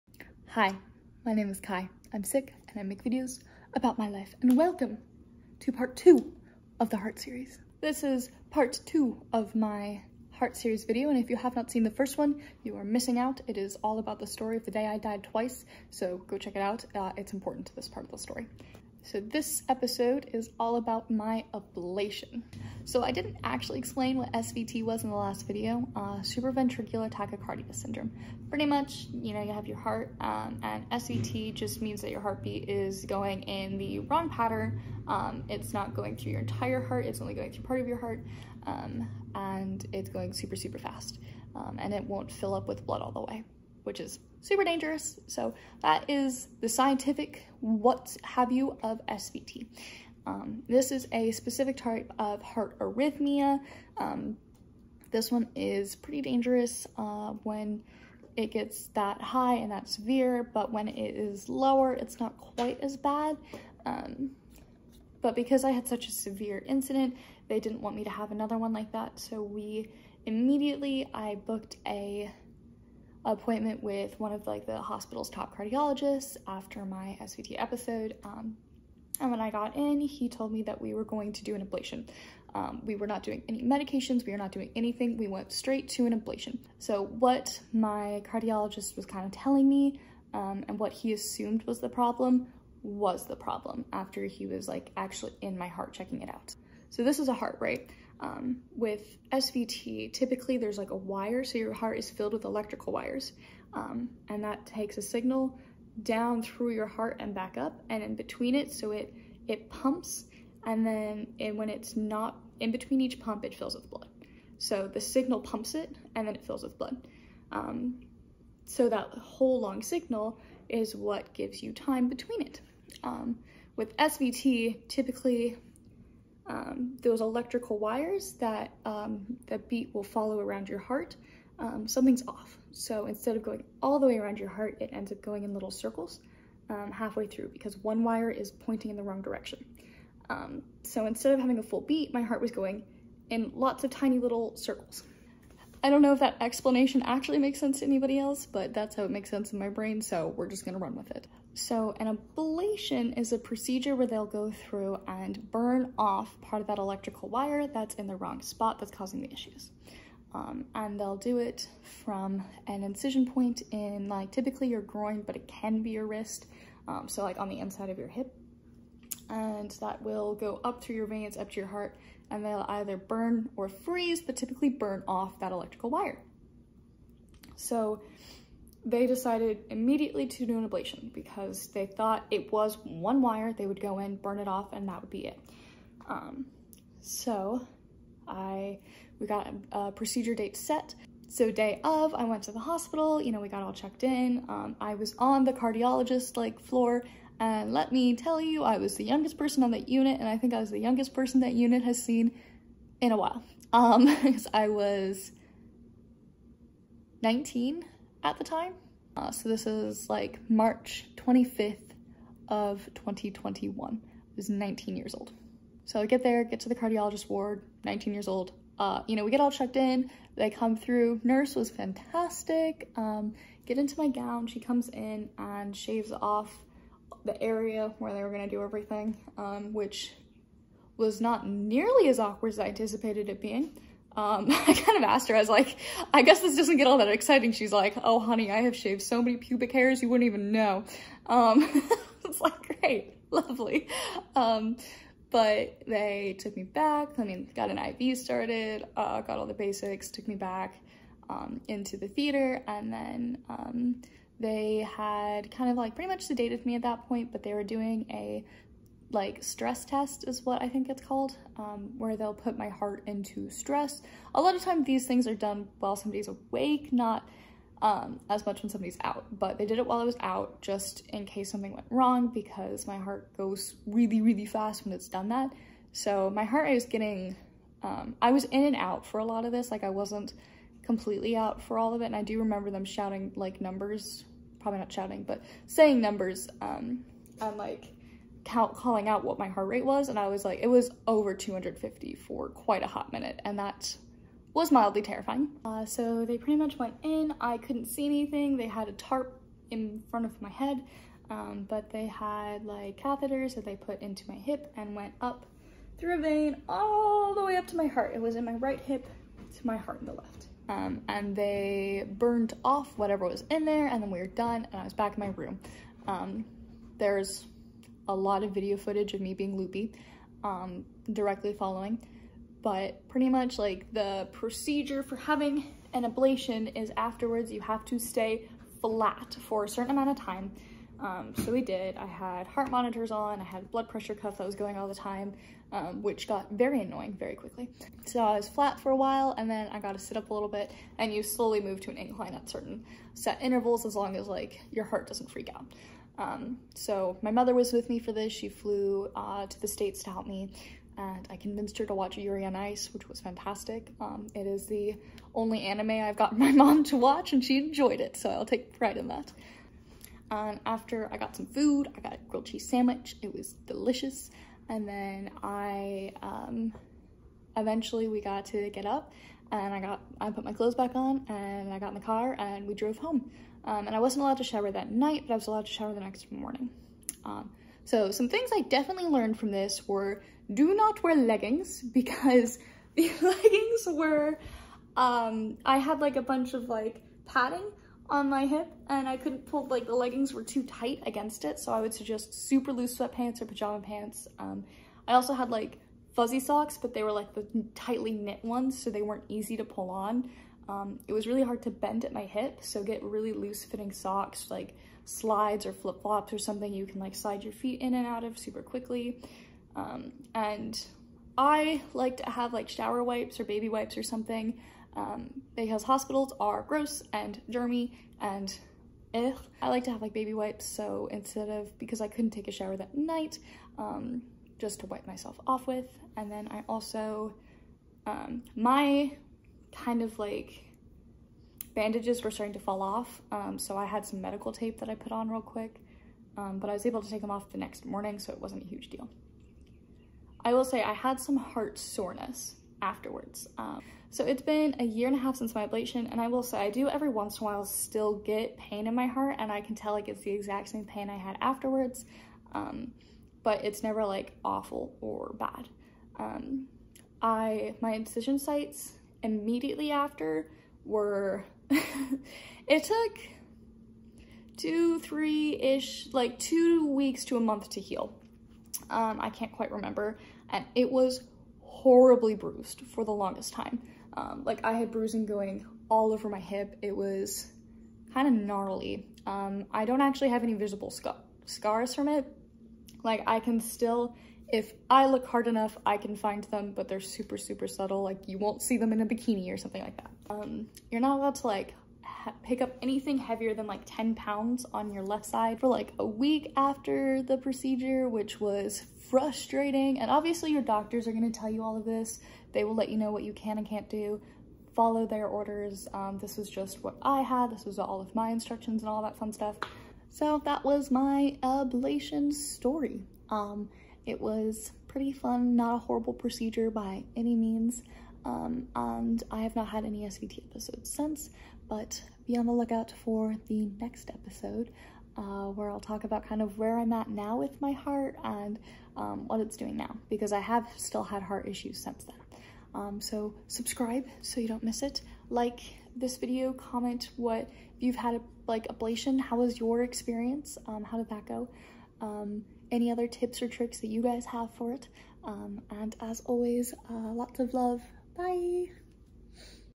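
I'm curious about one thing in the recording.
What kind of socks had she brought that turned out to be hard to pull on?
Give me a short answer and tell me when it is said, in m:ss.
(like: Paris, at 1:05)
Fuzzy socks, at 6:36.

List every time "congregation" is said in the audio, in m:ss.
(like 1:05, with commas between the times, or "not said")
not said.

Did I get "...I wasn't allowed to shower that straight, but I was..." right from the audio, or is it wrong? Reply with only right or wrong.
wrong.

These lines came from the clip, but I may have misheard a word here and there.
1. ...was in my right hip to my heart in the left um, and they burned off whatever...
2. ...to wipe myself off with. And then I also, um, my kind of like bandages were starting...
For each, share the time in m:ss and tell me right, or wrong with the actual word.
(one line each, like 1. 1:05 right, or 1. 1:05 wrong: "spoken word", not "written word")
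1. 5:08 right
2. 7:04 right.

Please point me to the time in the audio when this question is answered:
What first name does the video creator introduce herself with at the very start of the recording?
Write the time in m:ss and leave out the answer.
0:01.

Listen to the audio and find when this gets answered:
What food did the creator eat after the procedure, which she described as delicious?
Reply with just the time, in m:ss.
6:02.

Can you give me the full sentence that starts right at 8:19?
And obviously your doctors are gonna tell you all of this.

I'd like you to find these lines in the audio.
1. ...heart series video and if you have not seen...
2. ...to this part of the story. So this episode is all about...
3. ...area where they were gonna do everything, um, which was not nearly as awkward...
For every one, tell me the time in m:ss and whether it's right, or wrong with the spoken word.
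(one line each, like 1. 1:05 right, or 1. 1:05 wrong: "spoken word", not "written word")
1. 0:10 right
2. 0:17 right
3. 3:47 right.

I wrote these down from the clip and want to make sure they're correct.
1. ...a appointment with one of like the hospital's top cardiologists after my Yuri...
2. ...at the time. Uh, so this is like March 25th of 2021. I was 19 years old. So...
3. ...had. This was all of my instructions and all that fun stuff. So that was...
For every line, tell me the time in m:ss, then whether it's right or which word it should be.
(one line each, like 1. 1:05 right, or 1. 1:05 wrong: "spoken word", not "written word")
1. 1:11 wrong: "SVT", not "Yuri"
2. 3:28 right
3. 8:27 right.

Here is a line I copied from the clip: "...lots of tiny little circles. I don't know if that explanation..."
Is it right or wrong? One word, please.
right.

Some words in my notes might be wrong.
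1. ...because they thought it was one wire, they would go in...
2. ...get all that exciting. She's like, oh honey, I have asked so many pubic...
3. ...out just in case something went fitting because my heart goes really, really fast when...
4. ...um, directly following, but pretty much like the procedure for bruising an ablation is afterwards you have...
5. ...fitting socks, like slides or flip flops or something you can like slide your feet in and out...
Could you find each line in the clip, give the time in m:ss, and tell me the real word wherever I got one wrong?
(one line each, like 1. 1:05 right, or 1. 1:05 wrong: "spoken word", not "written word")
1. 3:01 right
2. 3:56 wrong: "shaved", not "asked"
3. 4:30 wrong: "wrong", not "fitting"
4. 5:20 wrong: "having", not "bruising"
5. 6:43 right.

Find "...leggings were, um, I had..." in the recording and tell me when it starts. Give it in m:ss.
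6:23.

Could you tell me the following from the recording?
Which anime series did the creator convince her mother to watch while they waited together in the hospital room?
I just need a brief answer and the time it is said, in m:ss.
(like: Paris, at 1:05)
Yuri on Ice, at 5:52.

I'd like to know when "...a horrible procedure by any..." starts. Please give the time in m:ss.
8:35.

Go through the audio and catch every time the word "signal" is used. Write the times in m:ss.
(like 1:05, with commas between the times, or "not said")
1:45, 1:55, 1:59.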